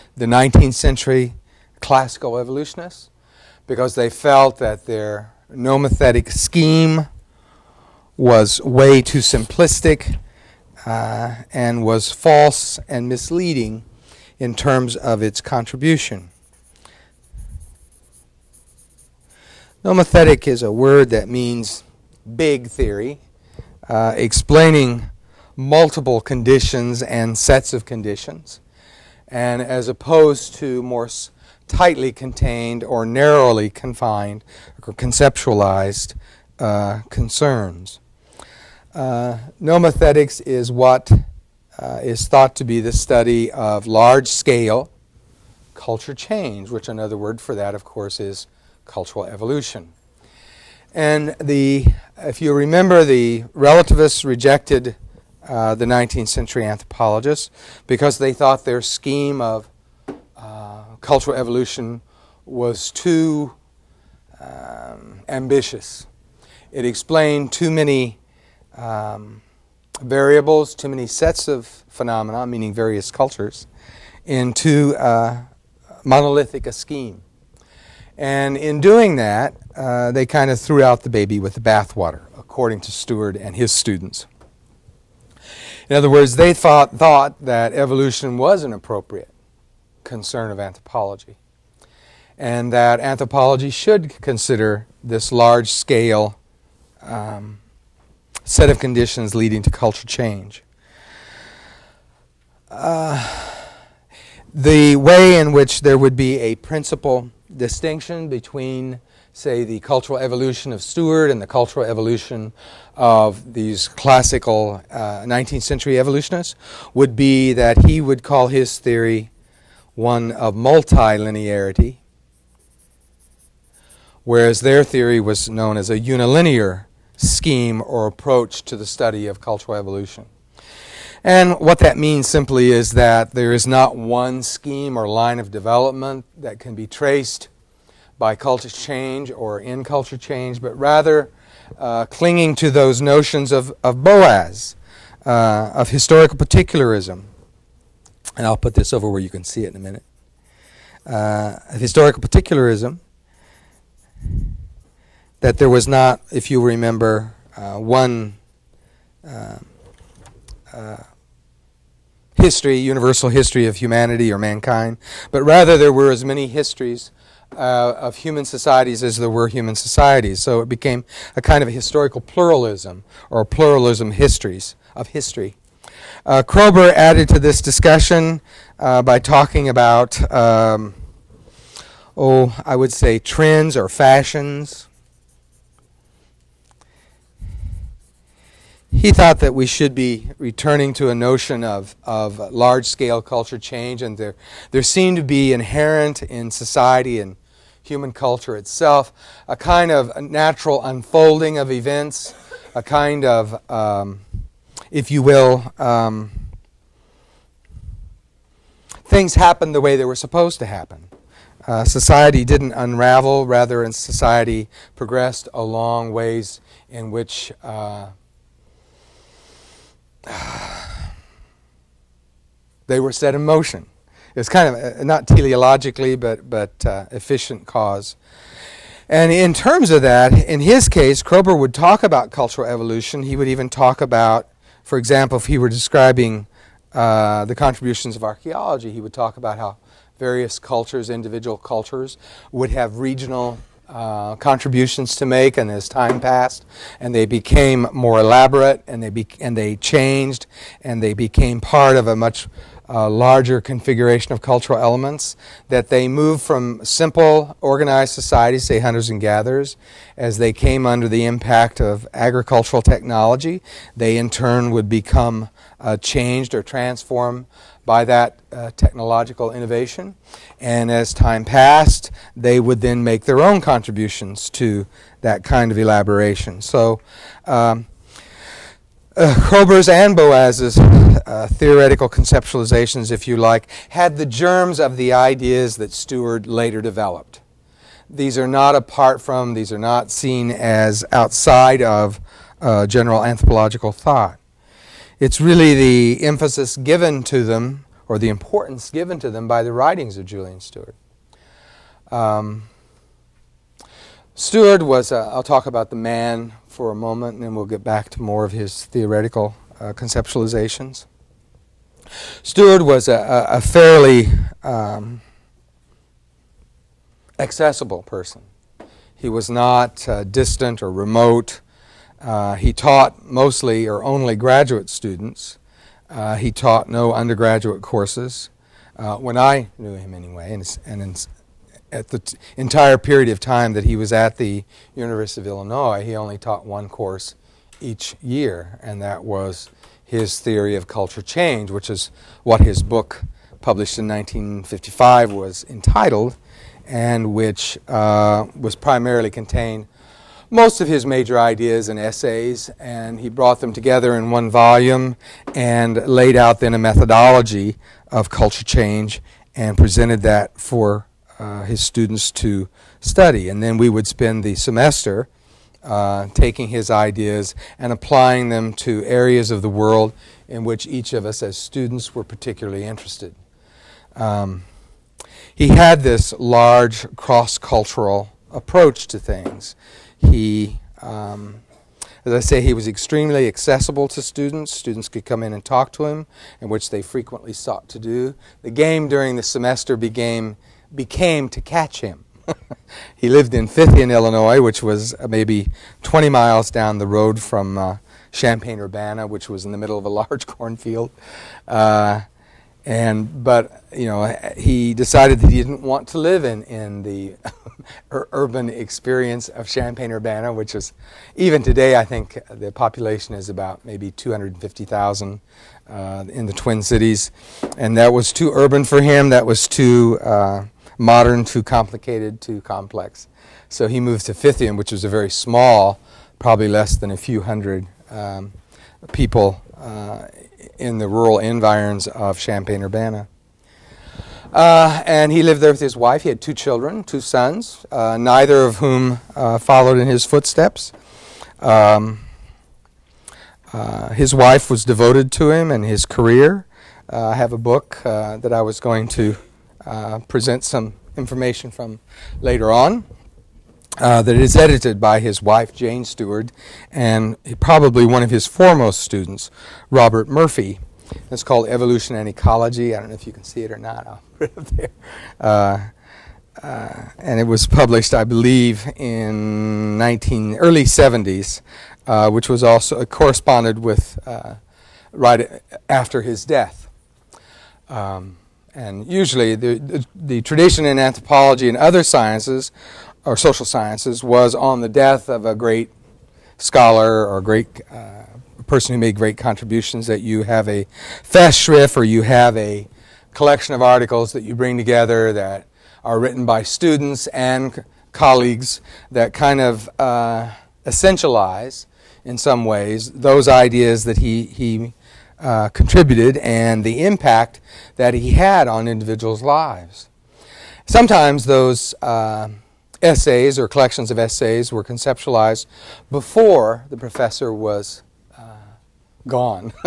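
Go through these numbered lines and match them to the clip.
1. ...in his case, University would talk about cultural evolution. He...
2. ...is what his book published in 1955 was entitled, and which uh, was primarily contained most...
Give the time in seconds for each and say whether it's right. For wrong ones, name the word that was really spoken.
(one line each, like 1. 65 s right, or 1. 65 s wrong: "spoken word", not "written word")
1. 230 s wrong: "Kroeber", not "University"
2. 341 s right.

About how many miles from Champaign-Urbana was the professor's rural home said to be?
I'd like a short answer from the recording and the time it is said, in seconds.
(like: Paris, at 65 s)
20, at 396 s.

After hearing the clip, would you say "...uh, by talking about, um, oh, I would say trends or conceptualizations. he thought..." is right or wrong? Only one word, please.
wrong.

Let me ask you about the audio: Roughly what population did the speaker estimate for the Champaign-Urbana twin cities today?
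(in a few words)
250,000.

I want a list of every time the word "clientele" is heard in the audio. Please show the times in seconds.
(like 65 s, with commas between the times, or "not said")
not said.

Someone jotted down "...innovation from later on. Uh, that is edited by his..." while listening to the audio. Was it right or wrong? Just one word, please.
wrong.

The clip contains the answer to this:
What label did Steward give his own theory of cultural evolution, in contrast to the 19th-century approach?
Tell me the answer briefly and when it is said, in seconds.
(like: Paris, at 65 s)
multilinearity, at 120 s.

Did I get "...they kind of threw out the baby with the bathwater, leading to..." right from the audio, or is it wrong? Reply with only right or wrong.
wrong.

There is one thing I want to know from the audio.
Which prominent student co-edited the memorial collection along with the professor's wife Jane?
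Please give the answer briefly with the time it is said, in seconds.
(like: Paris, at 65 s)
Robert Murphy, at 459 s.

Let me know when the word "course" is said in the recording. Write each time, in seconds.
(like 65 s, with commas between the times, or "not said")
47 s, 327 s, 336 s.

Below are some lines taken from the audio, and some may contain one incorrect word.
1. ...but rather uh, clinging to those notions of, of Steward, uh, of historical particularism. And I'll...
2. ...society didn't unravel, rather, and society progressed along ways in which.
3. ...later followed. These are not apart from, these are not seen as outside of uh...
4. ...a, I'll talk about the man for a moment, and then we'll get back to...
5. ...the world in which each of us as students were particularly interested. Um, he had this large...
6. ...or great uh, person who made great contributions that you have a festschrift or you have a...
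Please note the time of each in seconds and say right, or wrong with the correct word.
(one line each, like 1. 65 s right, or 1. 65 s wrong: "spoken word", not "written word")
1. 140 s wrong: "Boas", not "Steward"
2. 211 s right
3. 286 s wrong: "developed", not "followed"
4. 305 s right
5. 369 s right
6. 487 s right.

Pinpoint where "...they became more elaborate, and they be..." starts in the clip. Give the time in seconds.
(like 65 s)
247 s.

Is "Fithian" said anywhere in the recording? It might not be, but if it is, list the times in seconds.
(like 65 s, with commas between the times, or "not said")
393 s, 424 s.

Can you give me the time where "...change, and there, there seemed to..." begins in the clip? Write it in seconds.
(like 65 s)
193 s.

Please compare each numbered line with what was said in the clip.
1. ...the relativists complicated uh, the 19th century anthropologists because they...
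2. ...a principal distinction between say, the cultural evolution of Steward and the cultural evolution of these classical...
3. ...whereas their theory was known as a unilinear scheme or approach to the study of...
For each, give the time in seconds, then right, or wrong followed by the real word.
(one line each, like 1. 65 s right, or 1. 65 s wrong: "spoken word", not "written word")
1. 53 s wrong: "rejected", not "complicated"
2. 106 s right
3. 124 s right.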